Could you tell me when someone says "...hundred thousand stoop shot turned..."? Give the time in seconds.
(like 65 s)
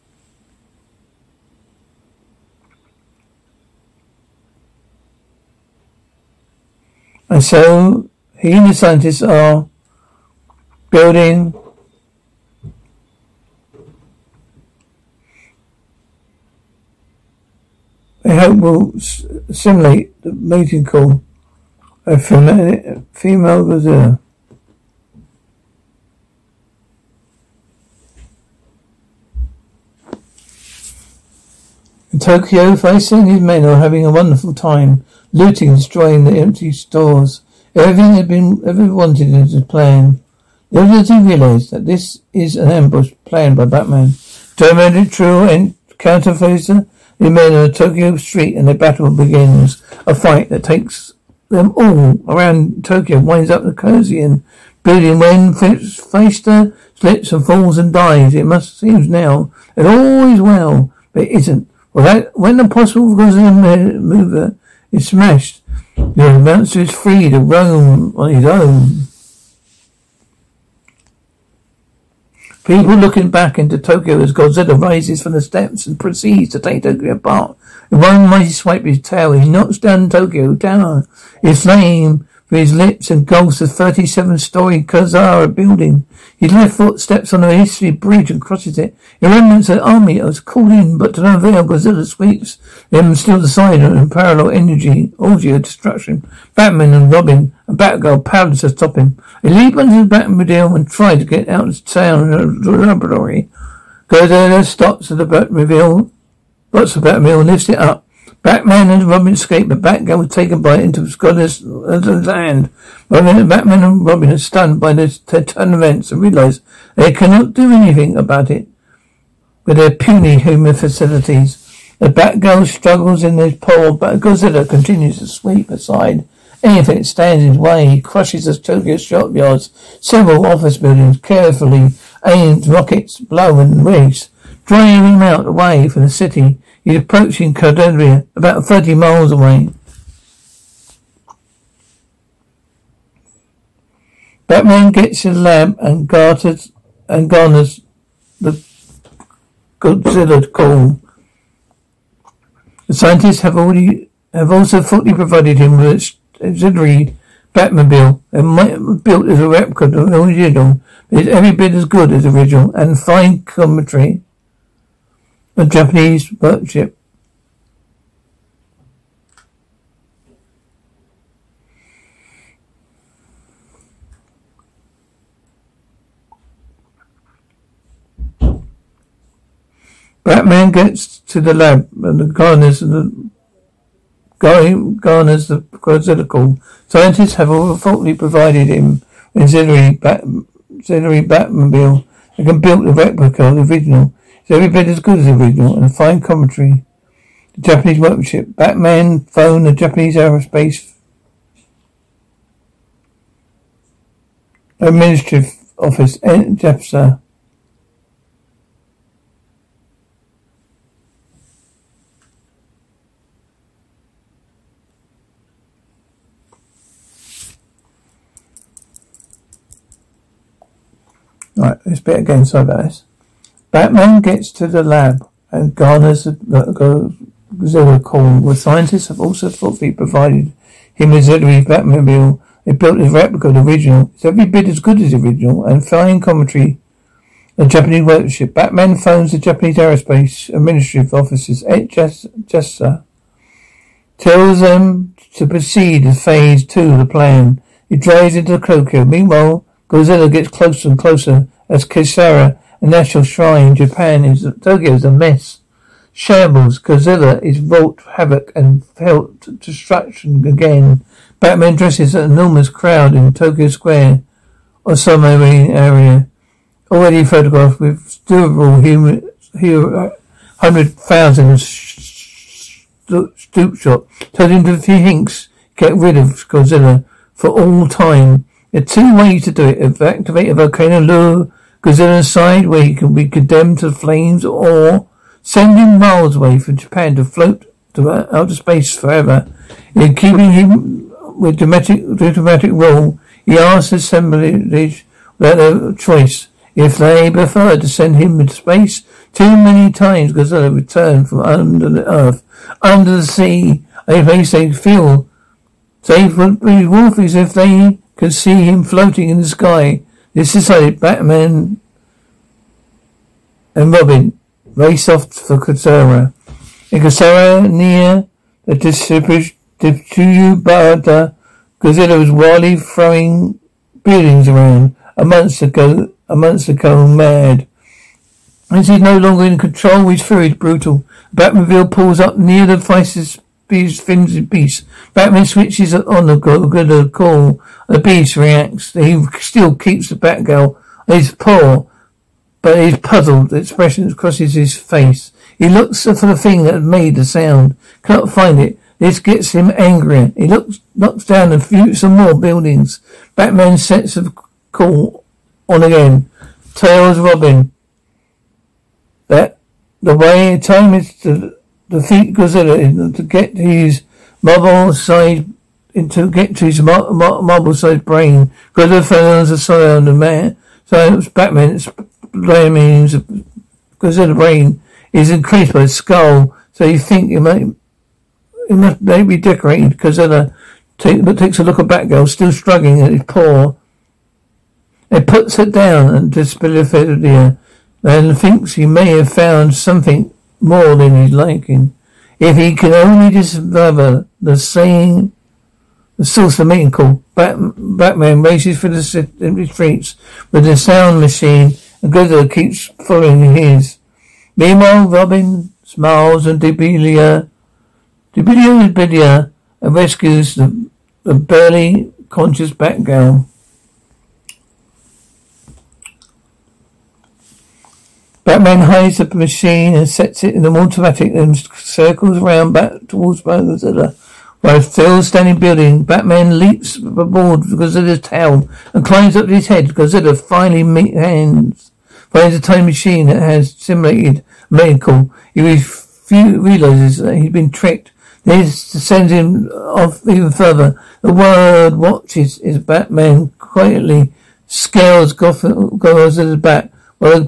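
270 s.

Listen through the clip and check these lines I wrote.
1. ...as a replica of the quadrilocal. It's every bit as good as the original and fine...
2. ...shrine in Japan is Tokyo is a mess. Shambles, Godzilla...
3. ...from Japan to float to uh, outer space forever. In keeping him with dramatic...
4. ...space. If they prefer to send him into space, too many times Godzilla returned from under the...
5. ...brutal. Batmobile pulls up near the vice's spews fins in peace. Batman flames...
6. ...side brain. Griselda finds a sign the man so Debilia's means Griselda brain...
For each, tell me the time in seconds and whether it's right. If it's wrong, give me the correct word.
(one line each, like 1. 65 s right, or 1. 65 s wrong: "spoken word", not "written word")
1. 159 s wrong: "original", not "quadrilocal"
2. 253 s right
3. 286 s right
4. 295 s wrong: "choice", not "space"
5. 330 s wrong: "switches", not "flames"
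6. 367 s wrong: "Batman", not "Debilia".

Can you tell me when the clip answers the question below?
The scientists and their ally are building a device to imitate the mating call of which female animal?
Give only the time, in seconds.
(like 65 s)
22 s.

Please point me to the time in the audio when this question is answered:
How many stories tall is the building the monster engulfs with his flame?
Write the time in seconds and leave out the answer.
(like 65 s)
83 s.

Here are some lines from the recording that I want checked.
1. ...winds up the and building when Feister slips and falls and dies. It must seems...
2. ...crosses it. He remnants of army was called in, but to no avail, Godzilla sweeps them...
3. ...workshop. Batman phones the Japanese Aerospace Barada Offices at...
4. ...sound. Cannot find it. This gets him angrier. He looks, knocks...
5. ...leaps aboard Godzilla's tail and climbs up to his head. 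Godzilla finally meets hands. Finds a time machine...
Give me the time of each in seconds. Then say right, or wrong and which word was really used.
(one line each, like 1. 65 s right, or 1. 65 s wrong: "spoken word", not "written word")
1. 53 s right
2. 88 s right
3. 238 s wrong: "Administrative", not "Barada"
4. 347 s right
5. 426 s right.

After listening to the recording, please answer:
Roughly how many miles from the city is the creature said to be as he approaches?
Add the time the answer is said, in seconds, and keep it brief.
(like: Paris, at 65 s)
30, at 138 s.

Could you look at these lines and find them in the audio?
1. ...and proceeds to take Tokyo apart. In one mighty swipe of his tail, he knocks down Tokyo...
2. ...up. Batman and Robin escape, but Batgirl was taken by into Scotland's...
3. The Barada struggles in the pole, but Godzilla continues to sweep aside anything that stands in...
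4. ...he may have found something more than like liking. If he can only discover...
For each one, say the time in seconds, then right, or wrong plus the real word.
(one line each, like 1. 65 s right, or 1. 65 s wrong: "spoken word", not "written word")
1. 75 s right
2. 107 s right
3. 121 s wrong: "Batgirl", not "Barada"
4. 388 s right.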